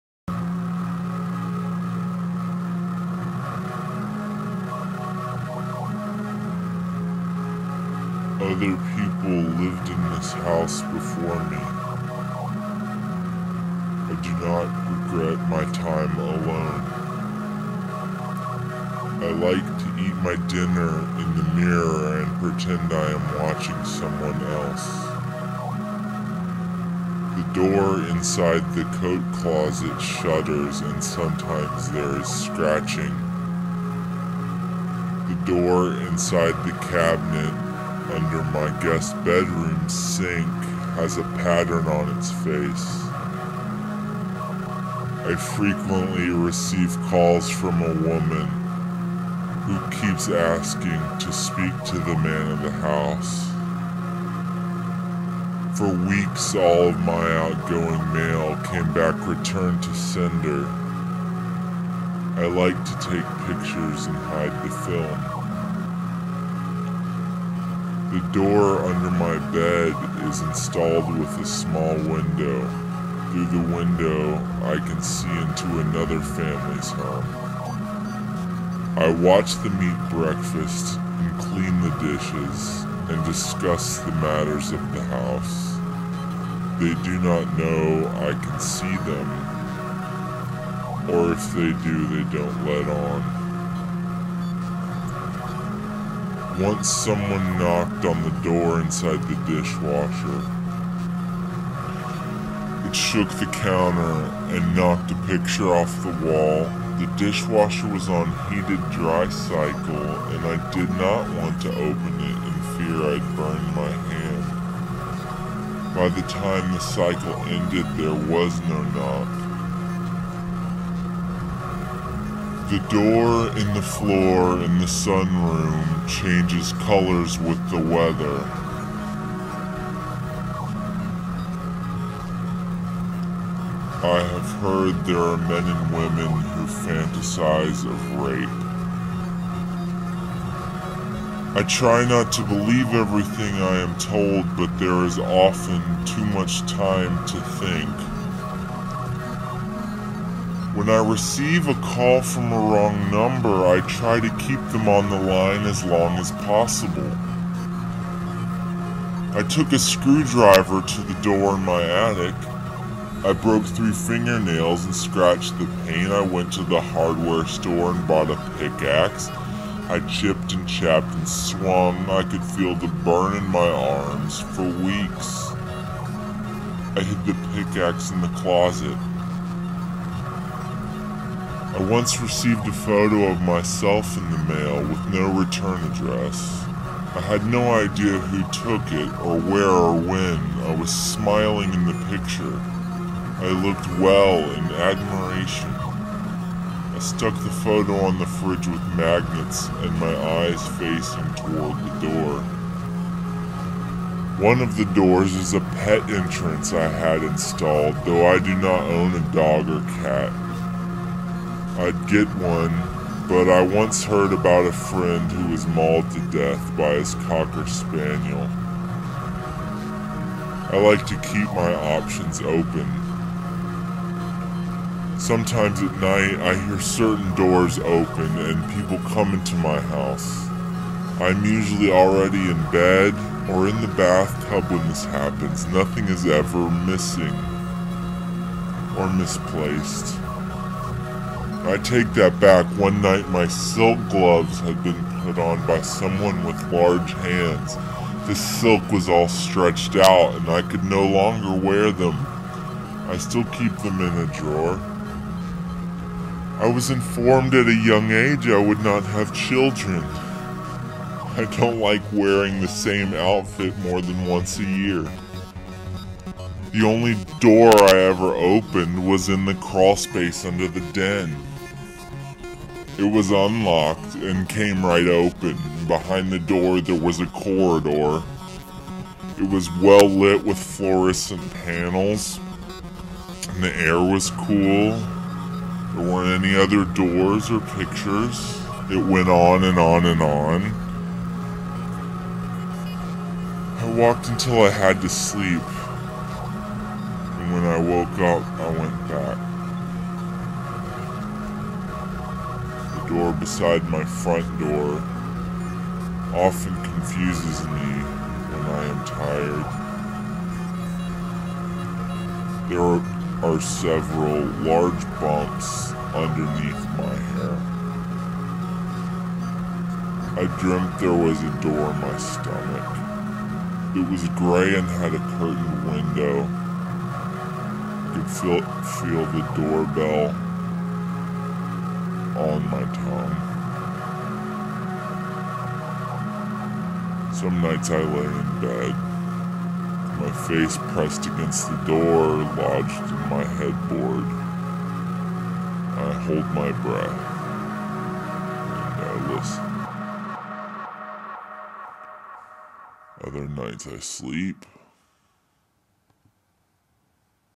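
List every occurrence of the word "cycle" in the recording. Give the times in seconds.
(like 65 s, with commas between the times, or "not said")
109 s, 116 s.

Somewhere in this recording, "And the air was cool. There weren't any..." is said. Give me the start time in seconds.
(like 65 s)
283 s.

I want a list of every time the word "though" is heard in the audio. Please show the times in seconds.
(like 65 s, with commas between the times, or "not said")
208 s.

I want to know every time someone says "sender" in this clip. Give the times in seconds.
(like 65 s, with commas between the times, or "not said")
59 s.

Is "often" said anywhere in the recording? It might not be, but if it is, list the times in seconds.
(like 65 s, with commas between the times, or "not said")
145 s, 306 s.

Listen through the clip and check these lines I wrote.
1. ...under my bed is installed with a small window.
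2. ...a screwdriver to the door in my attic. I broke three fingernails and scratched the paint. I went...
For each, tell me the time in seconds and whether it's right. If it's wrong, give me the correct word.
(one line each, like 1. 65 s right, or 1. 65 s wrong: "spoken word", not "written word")
1. 68 s right
2. 159 s right.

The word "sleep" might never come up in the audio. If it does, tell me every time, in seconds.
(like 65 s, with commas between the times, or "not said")
295 s, 353 s.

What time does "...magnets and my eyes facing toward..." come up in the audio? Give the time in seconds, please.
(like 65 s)
198 s.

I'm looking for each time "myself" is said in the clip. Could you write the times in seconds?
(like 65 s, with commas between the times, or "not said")
183 s.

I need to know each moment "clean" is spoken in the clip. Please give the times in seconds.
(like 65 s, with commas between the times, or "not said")
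81 s.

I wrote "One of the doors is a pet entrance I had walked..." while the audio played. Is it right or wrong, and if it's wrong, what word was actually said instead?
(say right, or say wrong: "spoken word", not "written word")
wrong: "installed", not "walked".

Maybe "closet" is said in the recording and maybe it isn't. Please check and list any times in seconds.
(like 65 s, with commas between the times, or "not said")
29 s, 178 s.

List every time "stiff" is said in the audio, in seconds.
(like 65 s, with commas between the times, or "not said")
not said.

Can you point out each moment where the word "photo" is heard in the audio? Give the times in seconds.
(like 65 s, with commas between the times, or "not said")
182 s, 197 s.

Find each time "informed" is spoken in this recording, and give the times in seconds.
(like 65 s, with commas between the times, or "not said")
256 s.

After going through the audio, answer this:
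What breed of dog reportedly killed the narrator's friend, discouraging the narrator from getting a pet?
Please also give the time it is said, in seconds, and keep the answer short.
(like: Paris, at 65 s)
cocker spaniel, at 217 s.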